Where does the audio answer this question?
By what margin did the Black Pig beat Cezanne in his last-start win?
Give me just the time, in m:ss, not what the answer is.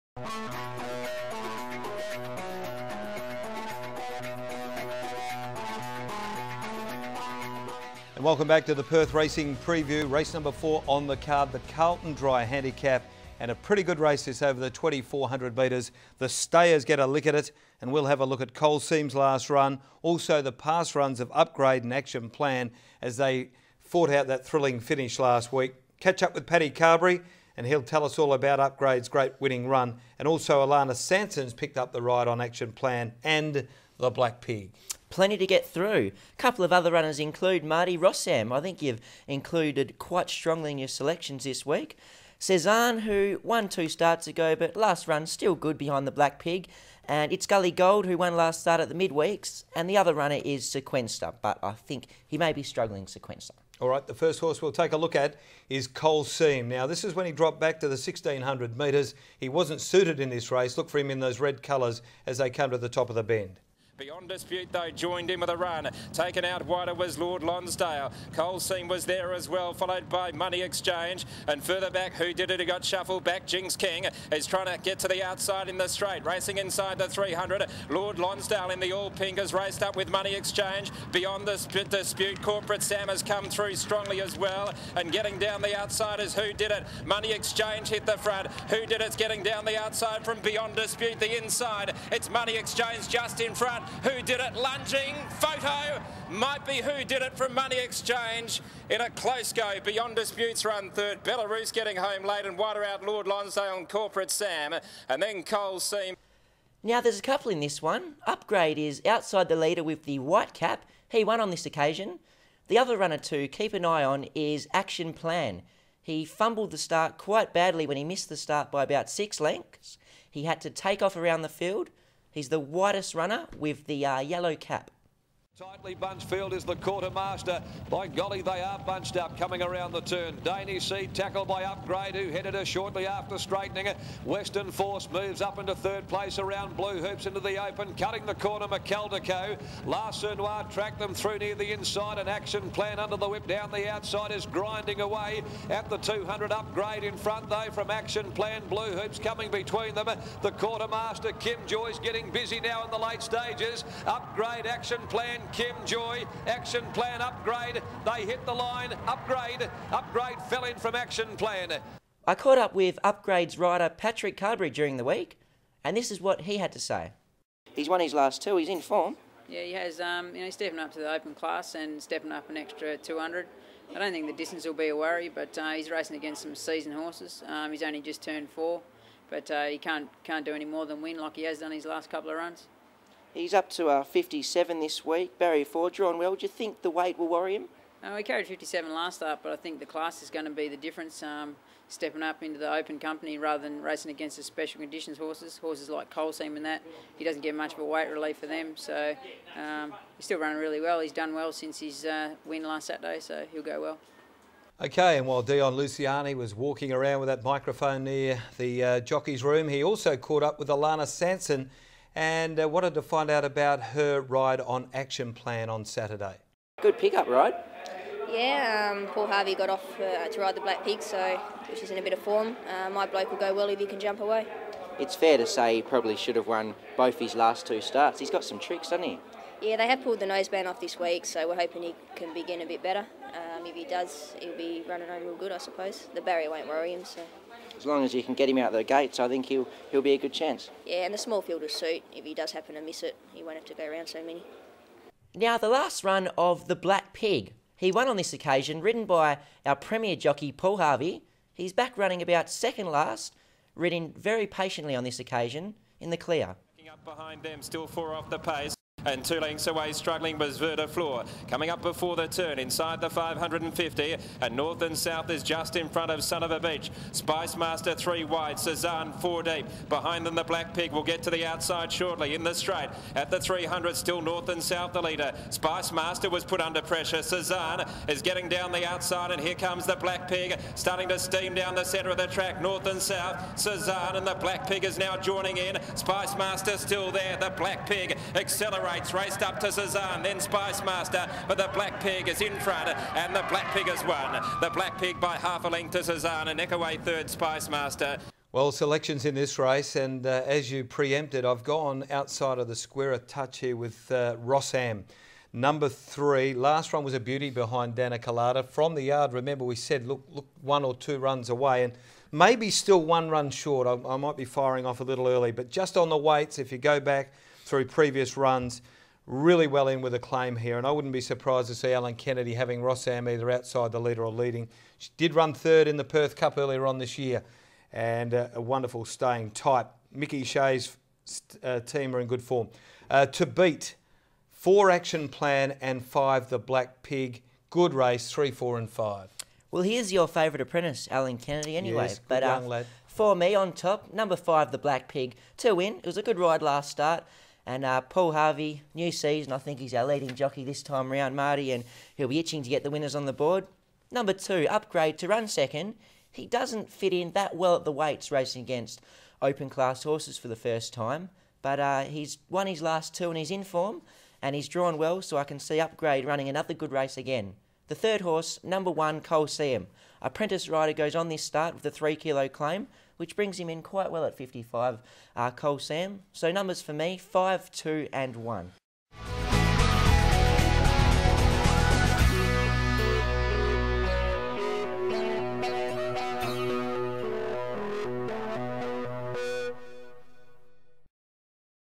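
4:55.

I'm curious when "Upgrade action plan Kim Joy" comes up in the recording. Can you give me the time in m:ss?
2:34.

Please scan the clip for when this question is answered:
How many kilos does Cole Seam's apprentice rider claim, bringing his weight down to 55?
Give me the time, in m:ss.
6:11.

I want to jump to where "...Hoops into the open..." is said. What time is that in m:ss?
2:17.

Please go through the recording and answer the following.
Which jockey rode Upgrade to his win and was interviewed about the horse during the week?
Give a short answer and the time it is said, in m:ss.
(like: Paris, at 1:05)
Patrick Carberry, at 2:43.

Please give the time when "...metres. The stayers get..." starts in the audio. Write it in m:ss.
0:15.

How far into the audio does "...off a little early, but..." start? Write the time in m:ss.
5:14.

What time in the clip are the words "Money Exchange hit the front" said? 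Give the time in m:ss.
1:27.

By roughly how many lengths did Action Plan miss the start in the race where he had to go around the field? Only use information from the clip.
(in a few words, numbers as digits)
6 lengths.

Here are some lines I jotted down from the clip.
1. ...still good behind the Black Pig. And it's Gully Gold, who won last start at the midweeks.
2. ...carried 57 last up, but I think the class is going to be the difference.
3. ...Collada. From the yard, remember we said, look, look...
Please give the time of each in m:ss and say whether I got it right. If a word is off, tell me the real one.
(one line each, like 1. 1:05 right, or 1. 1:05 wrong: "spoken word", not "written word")
1. 0:45 right
2. 3:08 right
3. 5:08 right.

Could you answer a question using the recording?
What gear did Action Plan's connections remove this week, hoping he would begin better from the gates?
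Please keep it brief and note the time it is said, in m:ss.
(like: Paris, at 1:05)
noseband, at 3:50.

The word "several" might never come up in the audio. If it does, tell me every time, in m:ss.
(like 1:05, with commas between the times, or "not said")
not said.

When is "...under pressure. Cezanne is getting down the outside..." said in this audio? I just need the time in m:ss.
4:36.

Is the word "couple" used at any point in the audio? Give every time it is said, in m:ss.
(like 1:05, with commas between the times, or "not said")
0:36, 1:47, 3:02.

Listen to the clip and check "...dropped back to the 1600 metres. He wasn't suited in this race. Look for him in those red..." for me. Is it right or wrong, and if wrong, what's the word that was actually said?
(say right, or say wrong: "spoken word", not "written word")
right.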